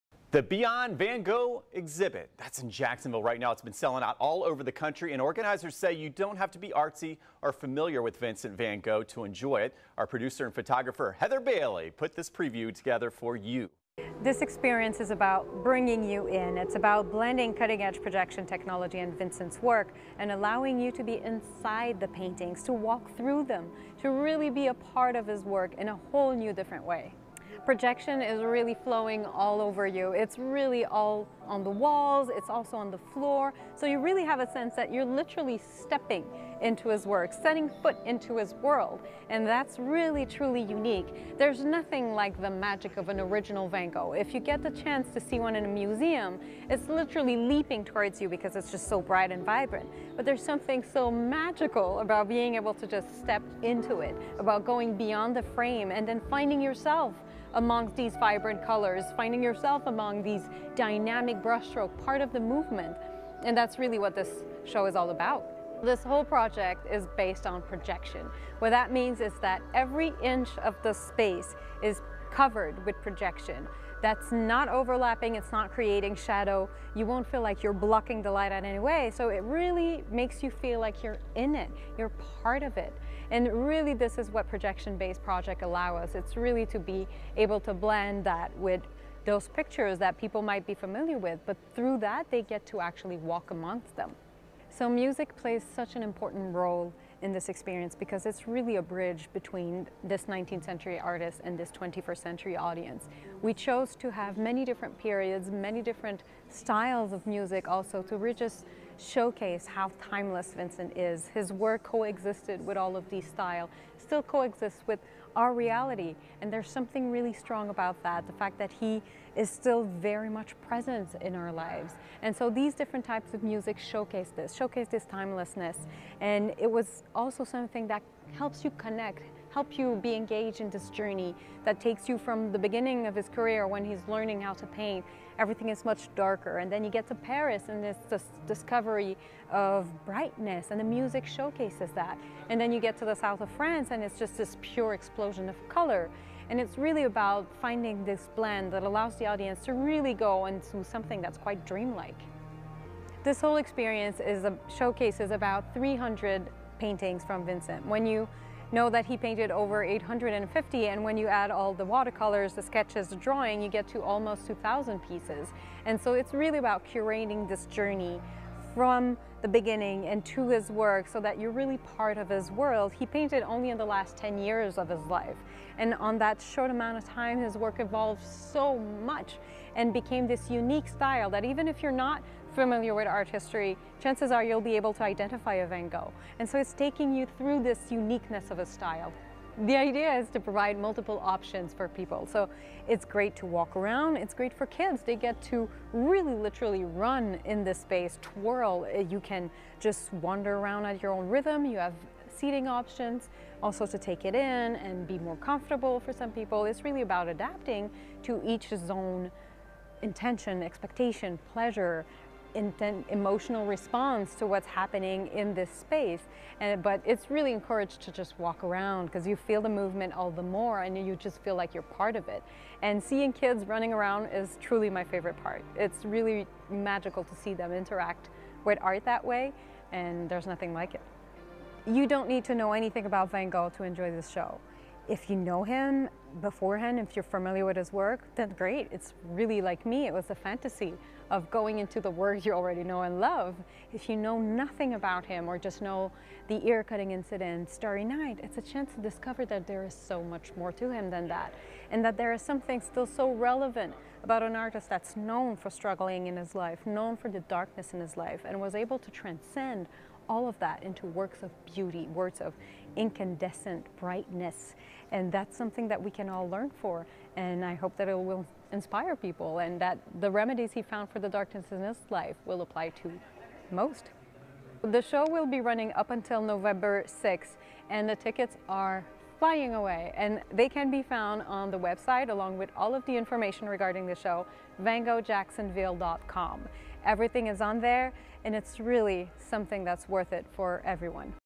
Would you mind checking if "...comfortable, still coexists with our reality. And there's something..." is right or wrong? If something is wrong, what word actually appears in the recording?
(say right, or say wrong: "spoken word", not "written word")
wrong: "style", not "comfortable".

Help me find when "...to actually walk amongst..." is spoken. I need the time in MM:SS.
01:32.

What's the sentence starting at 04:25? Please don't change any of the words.
And that's something that we can all learn for.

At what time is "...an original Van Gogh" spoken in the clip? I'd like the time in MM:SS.
00:43.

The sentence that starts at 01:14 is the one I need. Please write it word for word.
That's not overlapping, it's not creating shadow.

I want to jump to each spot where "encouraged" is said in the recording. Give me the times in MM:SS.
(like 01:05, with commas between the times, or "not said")
03:37.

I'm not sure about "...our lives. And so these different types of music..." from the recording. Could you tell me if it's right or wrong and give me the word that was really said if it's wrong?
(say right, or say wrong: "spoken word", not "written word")
right.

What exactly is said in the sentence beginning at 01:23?
And really this is what projection-based project allow us.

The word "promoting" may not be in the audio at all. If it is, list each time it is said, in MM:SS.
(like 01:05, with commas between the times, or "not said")
not said.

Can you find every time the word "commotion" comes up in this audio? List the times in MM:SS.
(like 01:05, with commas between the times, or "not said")
not said.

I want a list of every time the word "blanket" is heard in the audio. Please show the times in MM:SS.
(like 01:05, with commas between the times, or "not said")
not said.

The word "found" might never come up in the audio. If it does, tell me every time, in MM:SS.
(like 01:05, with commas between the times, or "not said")
04:30, 04:41.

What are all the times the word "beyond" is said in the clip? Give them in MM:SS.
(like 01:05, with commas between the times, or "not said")
00:00, 00:54.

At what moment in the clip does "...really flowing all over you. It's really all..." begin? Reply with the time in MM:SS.
00:28.